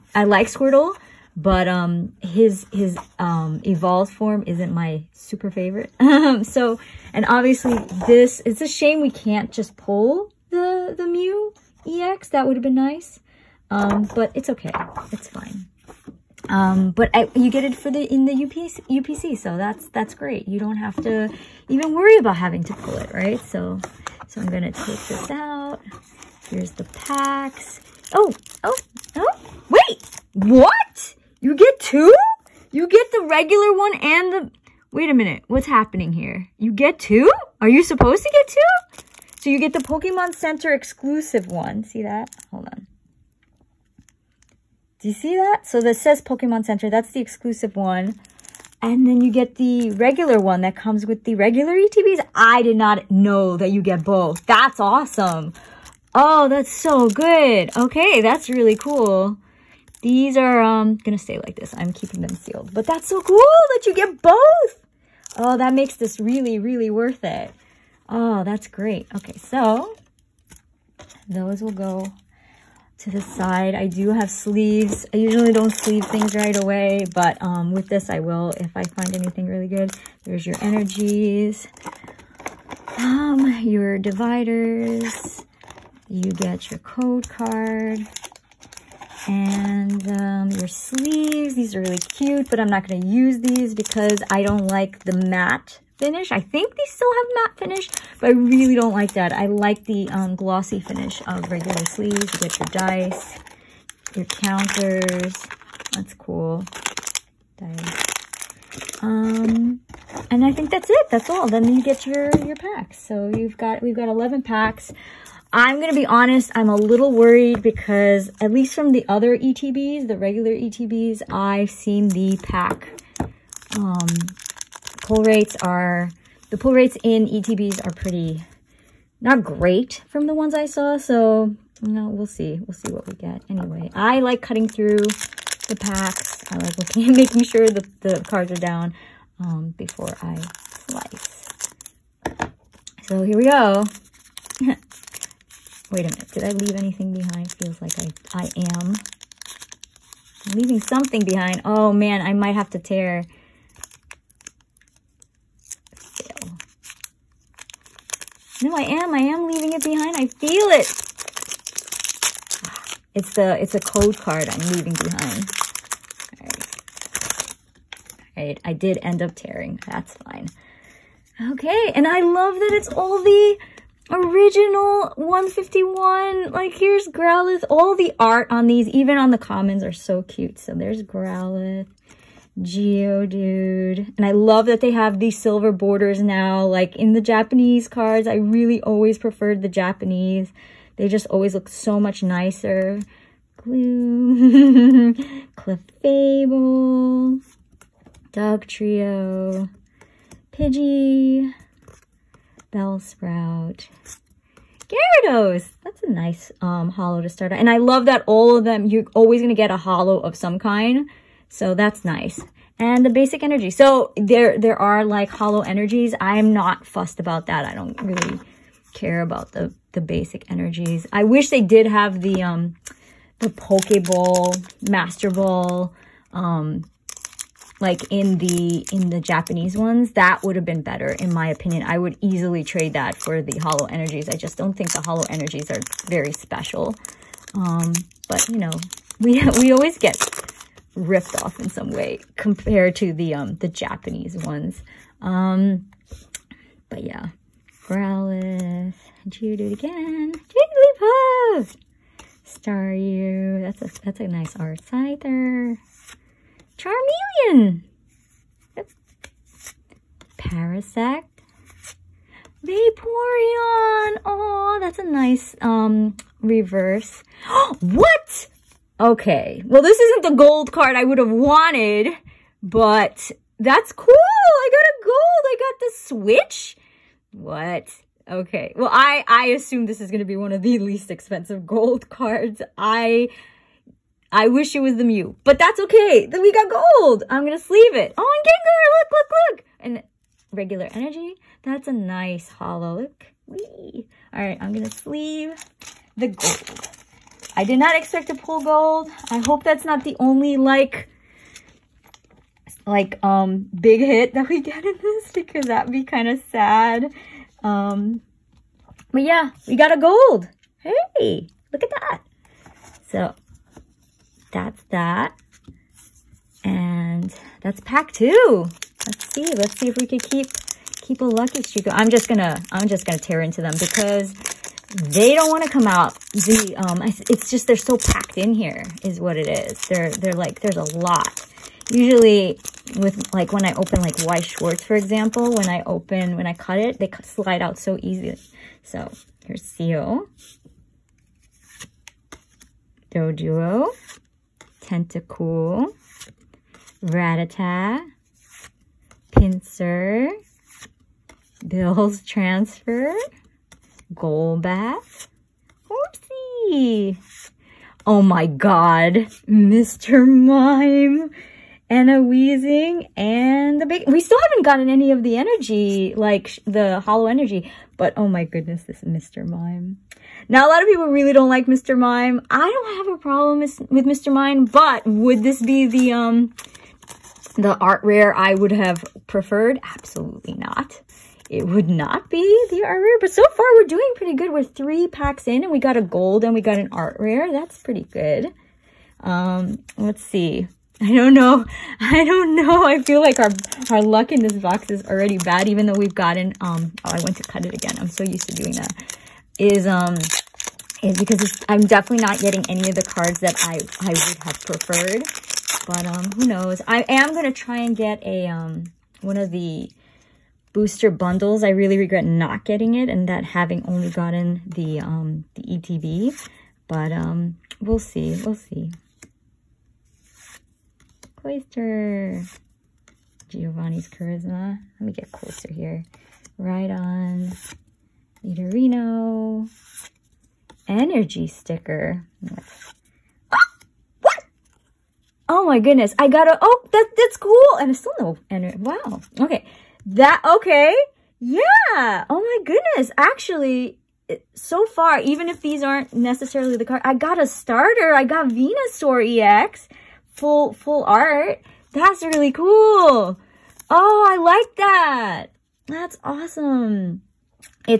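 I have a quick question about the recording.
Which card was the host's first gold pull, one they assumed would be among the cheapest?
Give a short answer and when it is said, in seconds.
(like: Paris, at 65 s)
Switch, at 275 s.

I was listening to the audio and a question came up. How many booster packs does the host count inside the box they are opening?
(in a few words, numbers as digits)
11.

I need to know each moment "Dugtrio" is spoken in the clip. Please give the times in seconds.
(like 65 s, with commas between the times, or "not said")
198 s.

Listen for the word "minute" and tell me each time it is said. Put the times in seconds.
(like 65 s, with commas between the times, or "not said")
35 s, 146 s.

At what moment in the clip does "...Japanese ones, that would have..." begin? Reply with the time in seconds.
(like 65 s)
229 s.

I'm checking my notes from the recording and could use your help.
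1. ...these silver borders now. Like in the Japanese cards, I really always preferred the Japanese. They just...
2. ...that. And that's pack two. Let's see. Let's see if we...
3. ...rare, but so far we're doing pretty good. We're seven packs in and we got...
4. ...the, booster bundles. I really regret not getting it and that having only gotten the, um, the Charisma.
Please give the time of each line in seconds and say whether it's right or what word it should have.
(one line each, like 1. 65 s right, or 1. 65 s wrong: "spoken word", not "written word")
1. 185 s right
2. 314 s right
3. 383 s wrong: "three", not "seven"
4. 409 s wrong: "ETB", not "Charisma".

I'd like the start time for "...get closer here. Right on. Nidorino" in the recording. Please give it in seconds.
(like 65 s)
425 s.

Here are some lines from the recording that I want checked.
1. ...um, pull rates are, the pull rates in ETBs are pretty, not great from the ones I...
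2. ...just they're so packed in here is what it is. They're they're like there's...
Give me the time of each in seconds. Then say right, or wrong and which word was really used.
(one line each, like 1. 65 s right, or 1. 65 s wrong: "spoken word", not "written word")
1. 123 s right
2. 327 s right.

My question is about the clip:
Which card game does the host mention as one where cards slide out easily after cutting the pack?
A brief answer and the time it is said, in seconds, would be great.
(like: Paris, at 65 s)
Weiss Schwarz, at 334 s.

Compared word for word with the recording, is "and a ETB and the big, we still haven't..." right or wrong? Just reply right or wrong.
wrong.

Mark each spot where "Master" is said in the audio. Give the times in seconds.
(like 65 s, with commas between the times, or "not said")
224 s.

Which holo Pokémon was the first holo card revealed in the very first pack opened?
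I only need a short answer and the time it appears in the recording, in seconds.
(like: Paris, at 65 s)
Gyarados, at 204 s.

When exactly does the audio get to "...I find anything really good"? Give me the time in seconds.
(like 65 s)
78 s.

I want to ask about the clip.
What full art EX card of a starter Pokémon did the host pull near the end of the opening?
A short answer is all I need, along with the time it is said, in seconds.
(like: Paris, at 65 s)
Venusaur EX, at 448 s.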